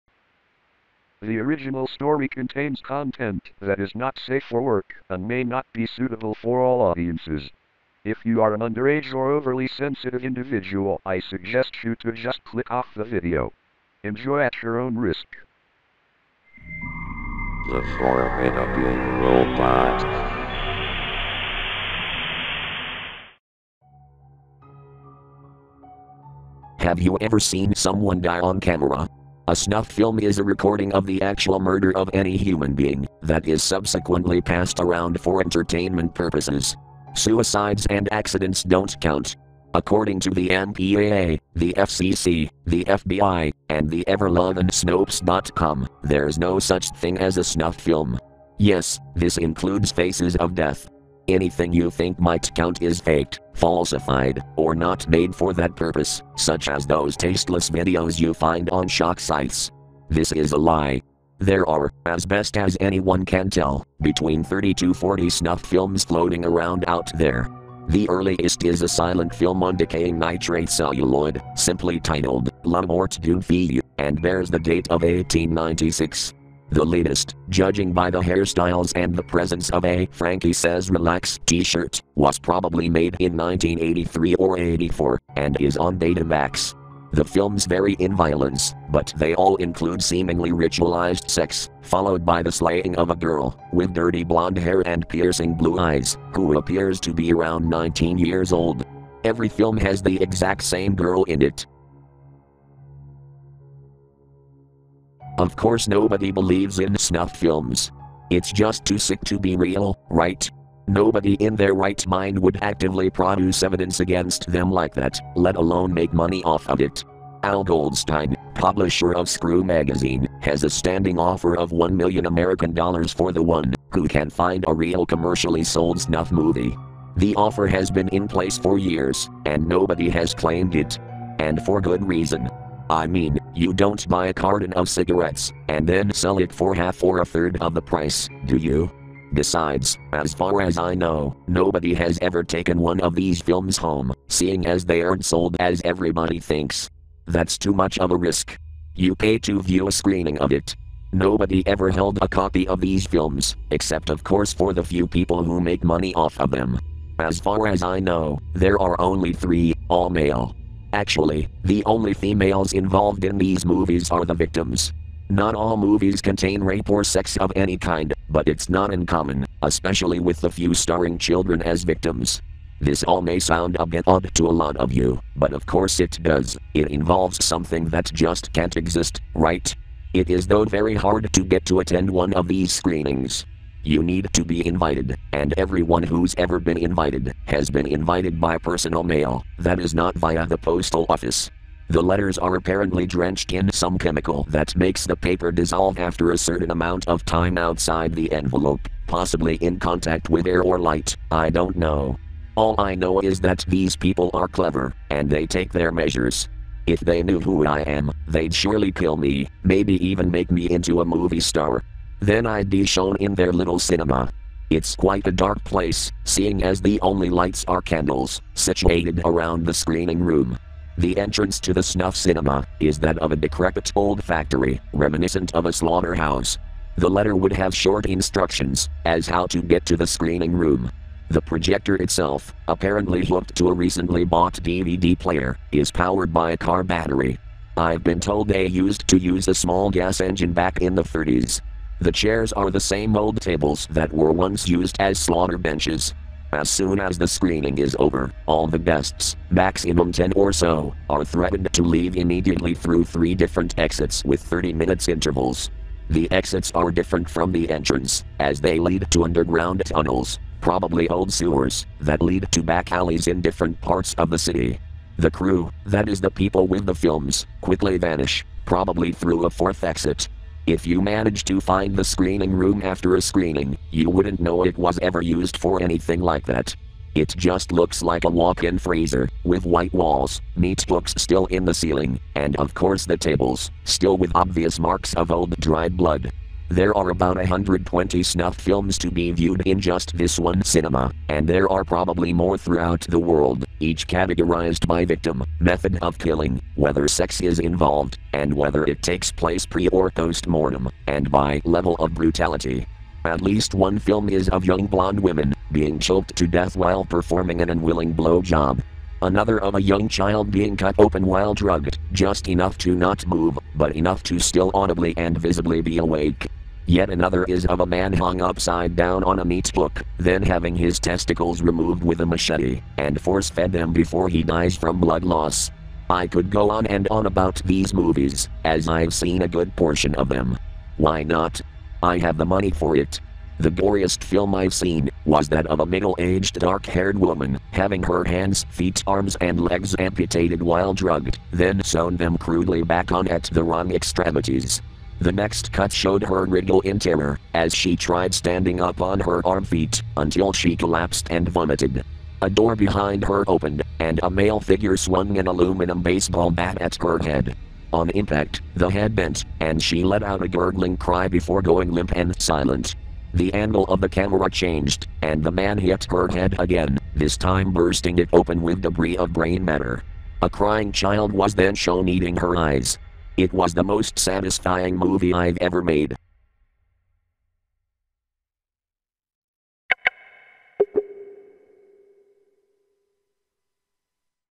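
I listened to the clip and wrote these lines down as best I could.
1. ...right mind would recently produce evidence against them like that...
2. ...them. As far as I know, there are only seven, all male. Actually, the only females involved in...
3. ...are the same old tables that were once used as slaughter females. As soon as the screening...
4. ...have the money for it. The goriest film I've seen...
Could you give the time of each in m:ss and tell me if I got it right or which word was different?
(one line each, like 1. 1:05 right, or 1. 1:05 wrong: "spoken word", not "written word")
1. 1:51 wrong: "actively", not "recently"
2. 2:36 wrong: "three", not "seven"
3. 4:02 wrong: "benches", not "females"
4. 5:32 right.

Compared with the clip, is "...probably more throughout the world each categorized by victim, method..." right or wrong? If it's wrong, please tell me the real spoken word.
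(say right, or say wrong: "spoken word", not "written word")
right.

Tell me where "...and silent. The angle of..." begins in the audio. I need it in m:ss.
6:02.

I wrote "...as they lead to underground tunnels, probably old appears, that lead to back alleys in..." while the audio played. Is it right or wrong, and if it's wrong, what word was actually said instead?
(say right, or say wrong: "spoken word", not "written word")
wrong: "sewers", not "appears".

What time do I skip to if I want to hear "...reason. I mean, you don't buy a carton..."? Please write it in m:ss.
2:12.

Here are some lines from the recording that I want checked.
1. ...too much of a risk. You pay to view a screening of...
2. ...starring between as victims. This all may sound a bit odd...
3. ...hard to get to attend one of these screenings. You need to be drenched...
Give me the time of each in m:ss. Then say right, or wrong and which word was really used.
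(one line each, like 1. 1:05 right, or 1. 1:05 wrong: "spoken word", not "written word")
1. 2:27 right
2. 2:50 wrong: "children", not "between"
3. 3:00 wrong: "invited", not "drenched".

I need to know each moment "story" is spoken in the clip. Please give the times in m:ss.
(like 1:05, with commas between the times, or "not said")
0:01.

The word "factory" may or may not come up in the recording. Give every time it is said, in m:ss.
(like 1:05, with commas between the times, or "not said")
3:44.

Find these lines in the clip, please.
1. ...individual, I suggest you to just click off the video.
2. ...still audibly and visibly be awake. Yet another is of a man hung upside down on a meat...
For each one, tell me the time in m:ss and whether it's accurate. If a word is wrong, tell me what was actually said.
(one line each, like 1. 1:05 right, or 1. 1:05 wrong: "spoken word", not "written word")
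1. 0:10 right
2. 5:14 right.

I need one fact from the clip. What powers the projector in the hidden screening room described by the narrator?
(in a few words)
A car battery.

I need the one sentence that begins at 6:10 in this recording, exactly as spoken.
A crying child was then shown eating her eyes, it was the most satisfying movie I've ever made.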